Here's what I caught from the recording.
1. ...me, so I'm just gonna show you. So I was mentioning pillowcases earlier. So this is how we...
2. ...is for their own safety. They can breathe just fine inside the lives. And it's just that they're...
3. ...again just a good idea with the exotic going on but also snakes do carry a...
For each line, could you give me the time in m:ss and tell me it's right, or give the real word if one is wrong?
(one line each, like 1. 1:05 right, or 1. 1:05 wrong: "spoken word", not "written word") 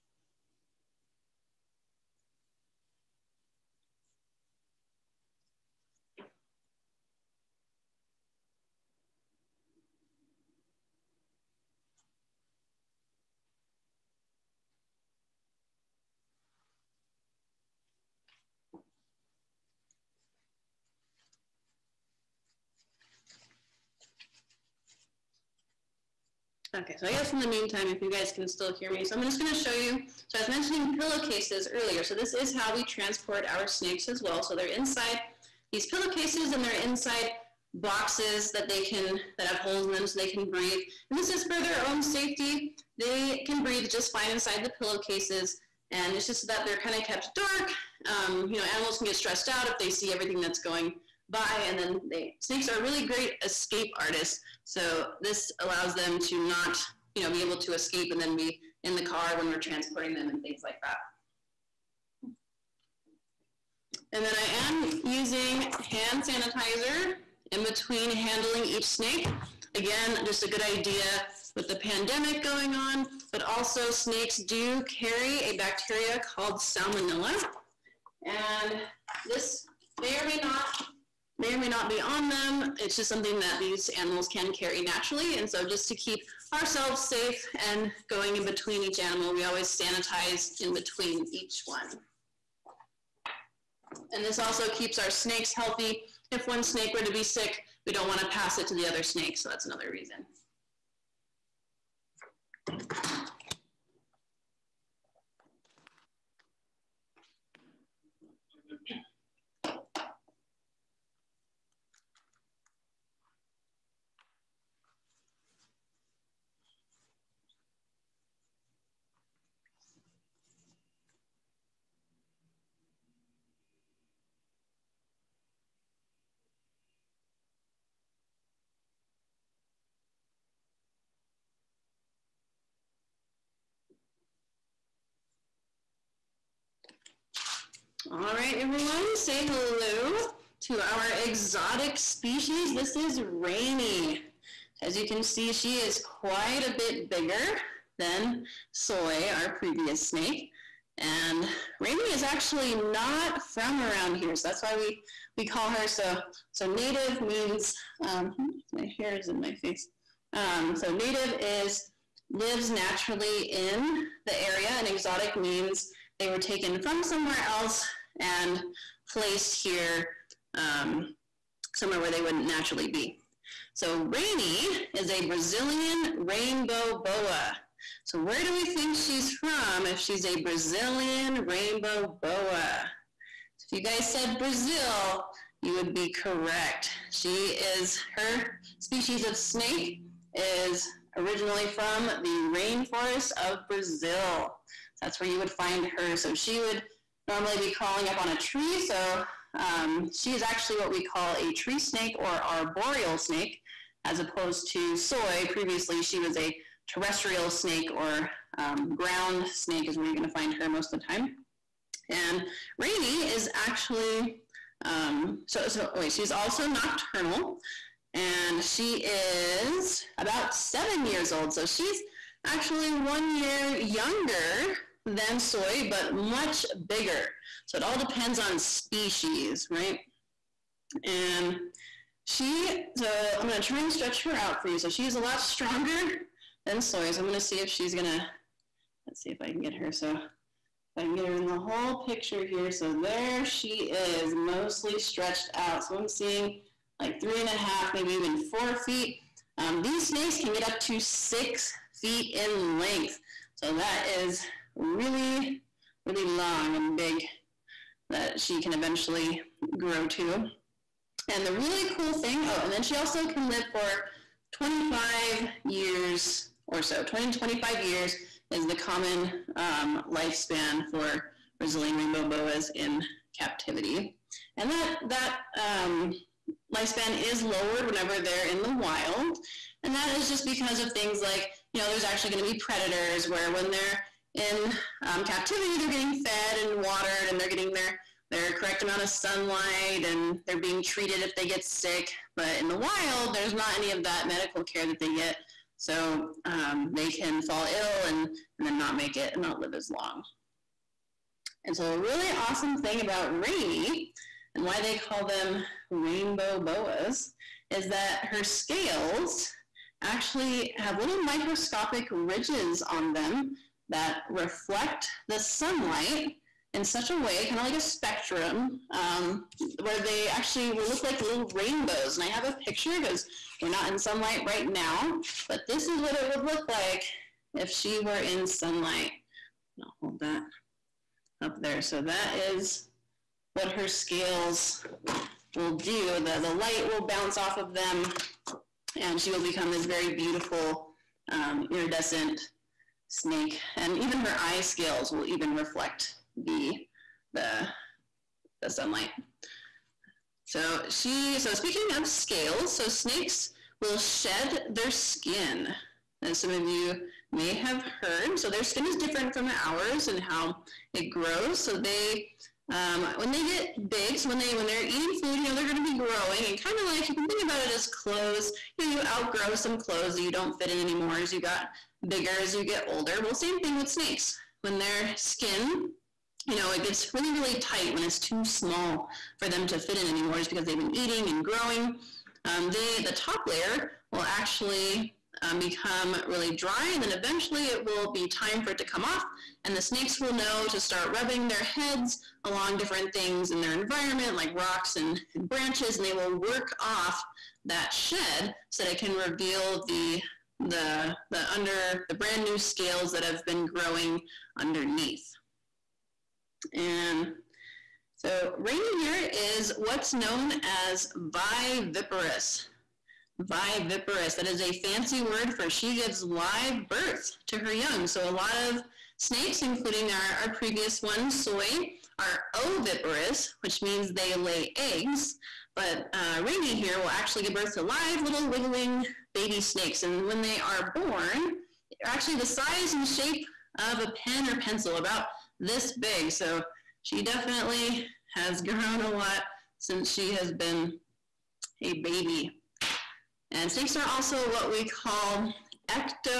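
1. 0:28 right
2. 0:41 wrong: "pillowcases", not "lives"
3. 1:09 wrong: "pandemic", not "exotic".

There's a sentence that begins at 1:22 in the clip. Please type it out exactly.
It's just something that these animals can carry naturally.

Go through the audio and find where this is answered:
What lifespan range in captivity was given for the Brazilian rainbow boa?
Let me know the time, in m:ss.
4:27.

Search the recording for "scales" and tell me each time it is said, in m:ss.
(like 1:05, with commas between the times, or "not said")
5:08, 5:33, 5:44, 5:52, 6:42.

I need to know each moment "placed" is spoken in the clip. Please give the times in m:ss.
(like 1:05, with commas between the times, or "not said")
2:49.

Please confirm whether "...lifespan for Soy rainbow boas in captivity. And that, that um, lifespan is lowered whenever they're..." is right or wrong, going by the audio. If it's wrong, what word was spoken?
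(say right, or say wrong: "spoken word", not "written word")
wrong: "Brazilian", not "Soy".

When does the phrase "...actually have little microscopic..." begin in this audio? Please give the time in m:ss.
5:10.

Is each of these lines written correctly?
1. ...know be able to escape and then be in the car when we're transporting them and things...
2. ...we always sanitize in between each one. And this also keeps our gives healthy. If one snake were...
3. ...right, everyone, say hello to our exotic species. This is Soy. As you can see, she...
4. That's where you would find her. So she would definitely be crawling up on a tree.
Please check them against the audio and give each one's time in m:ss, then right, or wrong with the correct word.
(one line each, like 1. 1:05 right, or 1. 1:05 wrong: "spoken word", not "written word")
1. 0:57 right
2. 1:29 wrong: "snakes", not "gives"
3. 2:18 wrong: "Rainy", not "Soy"
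4. 3:14 wrong: "normally", not "definitely".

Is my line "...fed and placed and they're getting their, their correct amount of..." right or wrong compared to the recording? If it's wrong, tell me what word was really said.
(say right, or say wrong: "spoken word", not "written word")
wrong: "watered", not "placed".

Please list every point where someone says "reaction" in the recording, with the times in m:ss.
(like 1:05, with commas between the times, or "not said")
not said.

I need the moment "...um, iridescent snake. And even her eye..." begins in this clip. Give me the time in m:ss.
5:41.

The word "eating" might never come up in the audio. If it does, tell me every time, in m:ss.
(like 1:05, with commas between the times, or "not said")
6:04, 6:20.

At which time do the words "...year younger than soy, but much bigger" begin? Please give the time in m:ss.
3:43.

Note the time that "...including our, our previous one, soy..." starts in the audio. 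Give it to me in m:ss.
6:59.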